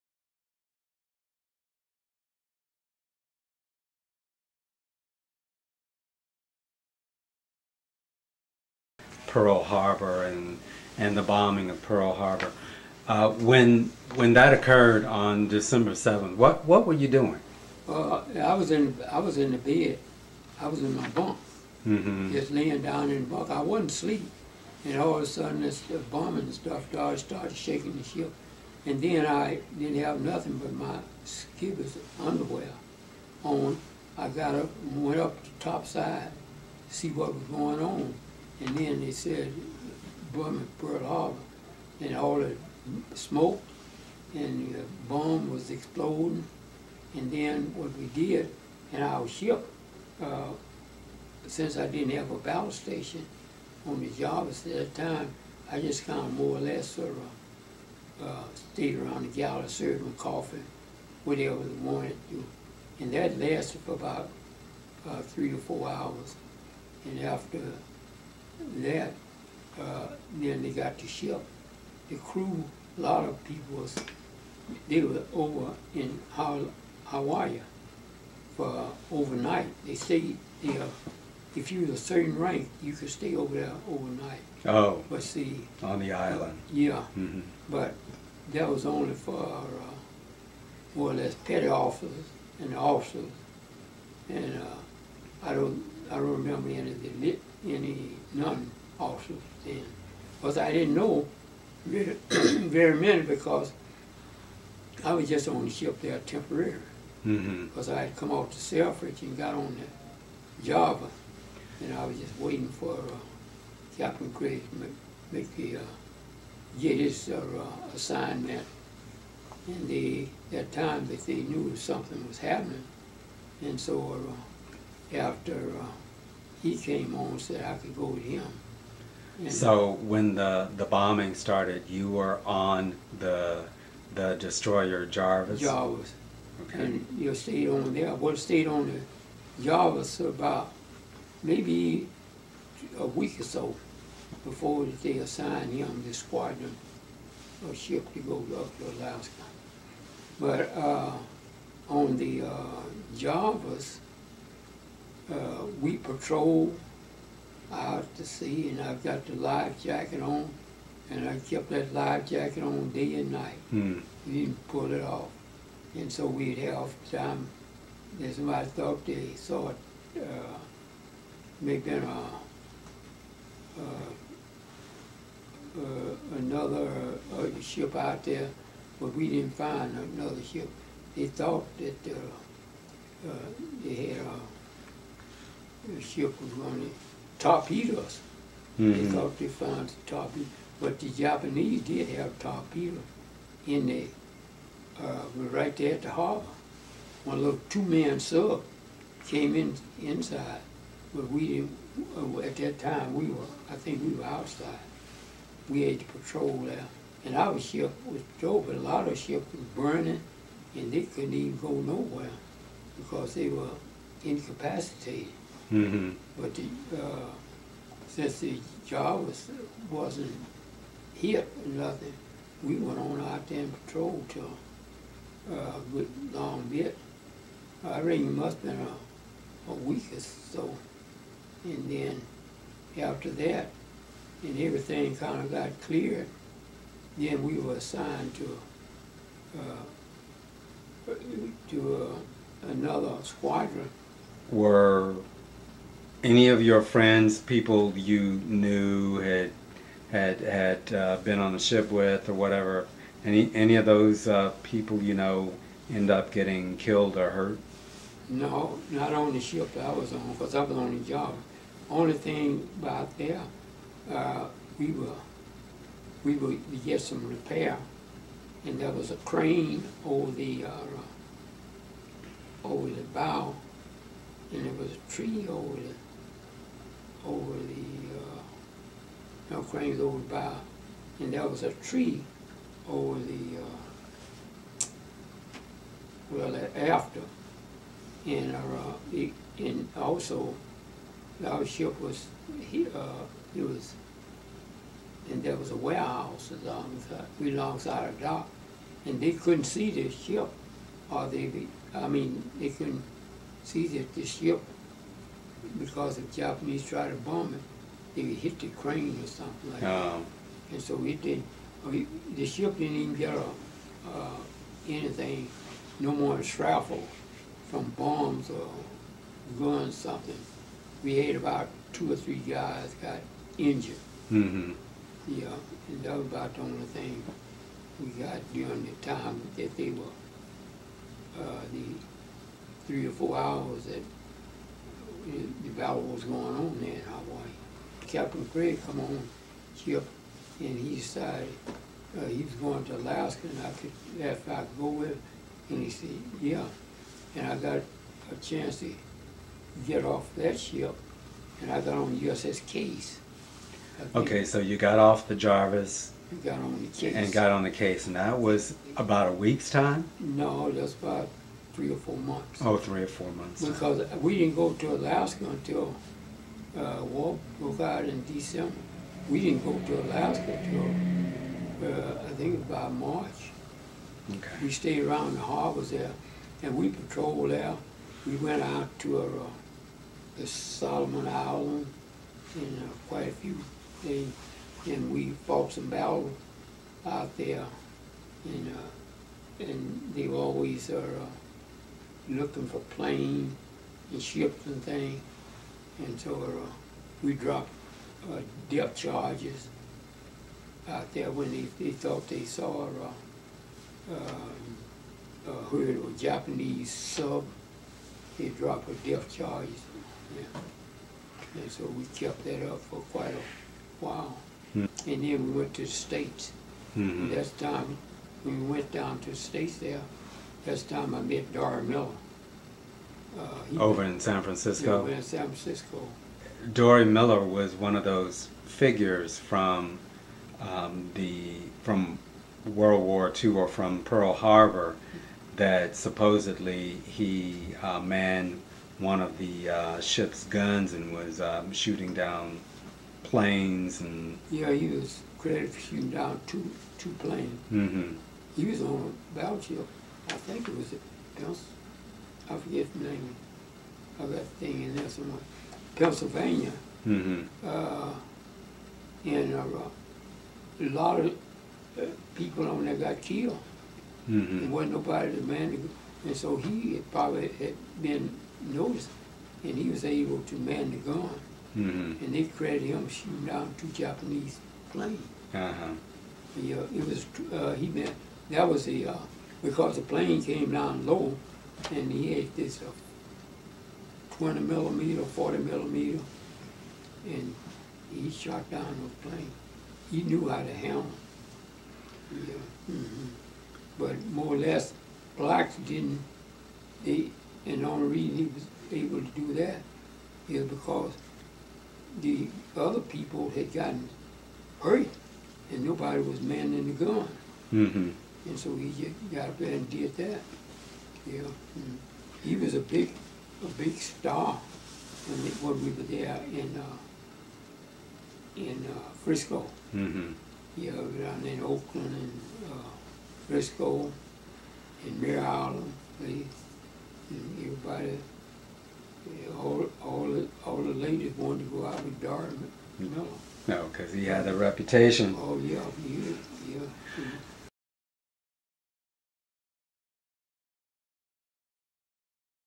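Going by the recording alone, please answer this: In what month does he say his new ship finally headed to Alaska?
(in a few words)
March.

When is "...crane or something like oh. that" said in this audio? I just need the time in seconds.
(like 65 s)
308 s.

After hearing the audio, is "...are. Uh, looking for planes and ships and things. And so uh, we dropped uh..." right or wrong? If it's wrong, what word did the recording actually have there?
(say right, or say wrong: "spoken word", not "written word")
right.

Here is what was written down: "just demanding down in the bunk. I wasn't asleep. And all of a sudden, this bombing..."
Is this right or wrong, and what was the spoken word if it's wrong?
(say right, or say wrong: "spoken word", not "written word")
wrong: "laying", not "demanding".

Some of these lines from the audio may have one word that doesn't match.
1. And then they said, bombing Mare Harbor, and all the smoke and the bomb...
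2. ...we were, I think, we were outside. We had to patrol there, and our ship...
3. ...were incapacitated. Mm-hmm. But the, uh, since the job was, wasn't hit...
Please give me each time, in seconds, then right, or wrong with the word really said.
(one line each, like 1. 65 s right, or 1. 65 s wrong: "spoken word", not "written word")
1. 38 s wrong: "Pearl", not "Mare"
2. 203 s right
3. 213 s right.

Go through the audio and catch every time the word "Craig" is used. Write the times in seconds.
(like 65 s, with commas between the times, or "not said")
338 s.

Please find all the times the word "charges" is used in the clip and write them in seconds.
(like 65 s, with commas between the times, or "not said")
398 s, 409 s.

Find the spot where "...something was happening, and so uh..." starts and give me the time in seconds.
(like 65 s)
121 s.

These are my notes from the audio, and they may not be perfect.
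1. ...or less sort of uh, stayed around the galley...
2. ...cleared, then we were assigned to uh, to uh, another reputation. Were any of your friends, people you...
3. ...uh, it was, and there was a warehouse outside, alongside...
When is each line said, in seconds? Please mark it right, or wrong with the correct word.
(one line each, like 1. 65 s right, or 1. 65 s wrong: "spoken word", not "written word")
1. 56 s right
2. 235 s wrong: "squadron", not "reputation"
3. 292 s wrong: "alongside", not "outside".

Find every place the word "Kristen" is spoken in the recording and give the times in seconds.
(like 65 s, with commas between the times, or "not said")
not said.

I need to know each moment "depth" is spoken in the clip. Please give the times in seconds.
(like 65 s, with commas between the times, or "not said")
398 s, 409 s.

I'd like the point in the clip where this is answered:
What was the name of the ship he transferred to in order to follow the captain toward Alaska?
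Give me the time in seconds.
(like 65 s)
352 s.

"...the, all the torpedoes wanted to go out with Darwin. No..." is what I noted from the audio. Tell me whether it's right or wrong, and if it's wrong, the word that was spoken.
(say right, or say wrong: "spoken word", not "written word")
wrong: "ladies", not "torpedoes".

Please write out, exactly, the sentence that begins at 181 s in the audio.
They thought that uh, they had a the ship was going to torpedo us.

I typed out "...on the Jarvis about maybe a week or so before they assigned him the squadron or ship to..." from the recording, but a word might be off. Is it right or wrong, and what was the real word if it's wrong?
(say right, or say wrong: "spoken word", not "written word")
right.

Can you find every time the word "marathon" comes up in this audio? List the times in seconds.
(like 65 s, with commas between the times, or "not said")
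not said.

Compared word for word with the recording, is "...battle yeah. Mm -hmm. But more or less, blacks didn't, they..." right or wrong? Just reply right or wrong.
wrong.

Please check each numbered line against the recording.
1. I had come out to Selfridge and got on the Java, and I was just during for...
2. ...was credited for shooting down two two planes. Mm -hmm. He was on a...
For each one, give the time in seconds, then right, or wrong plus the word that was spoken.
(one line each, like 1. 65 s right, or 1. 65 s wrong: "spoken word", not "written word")
1. 107 s wrong: "waiting", not "during"
2. 444 s right.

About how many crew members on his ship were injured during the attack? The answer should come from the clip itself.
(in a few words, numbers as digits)
two or three.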